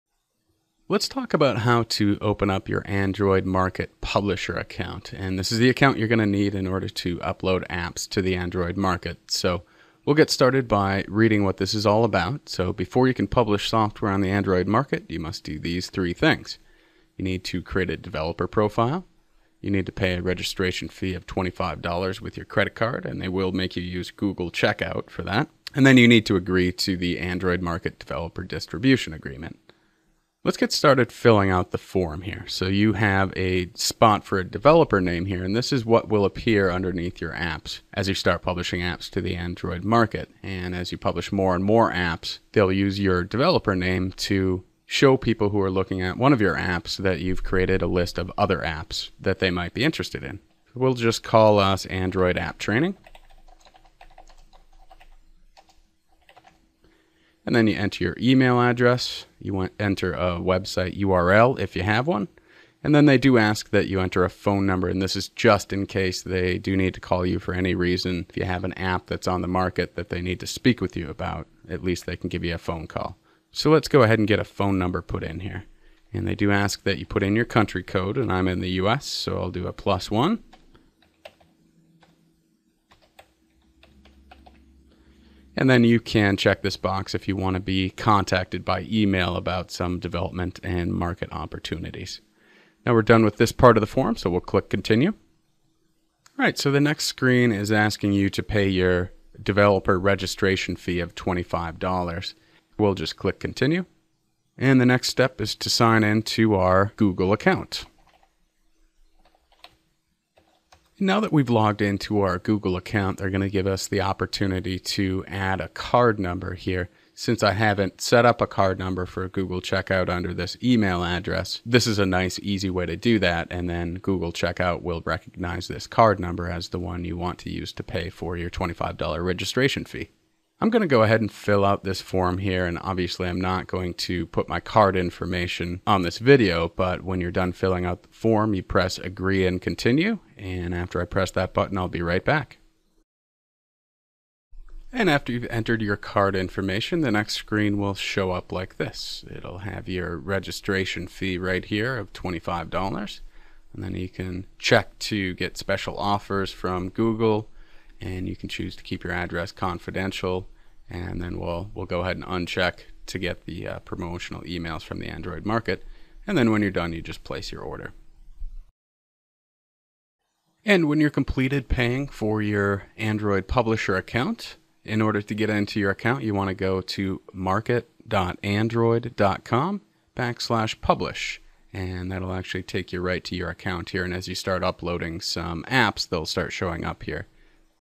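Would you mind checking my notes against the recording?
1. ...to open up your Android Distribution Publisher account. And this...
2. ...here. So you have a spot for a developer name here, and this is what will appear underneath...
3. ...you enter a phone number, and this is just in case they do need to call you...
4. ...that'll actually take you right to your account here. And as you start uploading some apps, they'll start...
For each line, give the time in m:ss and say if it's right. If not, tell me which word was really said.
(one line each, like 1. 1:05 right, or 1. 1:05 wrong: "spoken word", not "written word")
1. 0:01 wrong: "Market", not "Distribution"
2. 0:32 right
3. 1:03 right
4. 3:02 right.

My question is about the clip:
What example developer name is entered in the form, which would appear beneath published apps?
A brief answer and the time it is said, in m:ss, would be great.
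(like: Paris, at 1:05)
Android App Training, at 0:51.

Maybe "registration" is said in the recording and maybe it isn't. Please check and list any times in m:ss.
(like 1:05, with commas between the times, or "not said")
0:20, 1:39, 2:09, 2:30.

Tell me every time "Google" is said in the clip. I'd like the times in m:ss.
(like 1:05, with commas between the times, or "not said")
0:24, 1:46, 1:52, 1:59, 2:03, 2:36.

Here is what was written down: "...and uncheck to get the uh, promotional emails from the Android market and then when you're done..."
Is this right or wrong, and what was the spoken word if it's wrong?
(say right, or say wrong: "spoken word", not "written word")
right.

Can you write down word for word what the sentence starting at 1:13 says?
So let's go ahead and get a phone number put in here.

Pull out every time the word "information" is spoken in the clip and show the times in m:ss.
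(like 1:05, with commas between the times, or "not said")
2:14, 2:26.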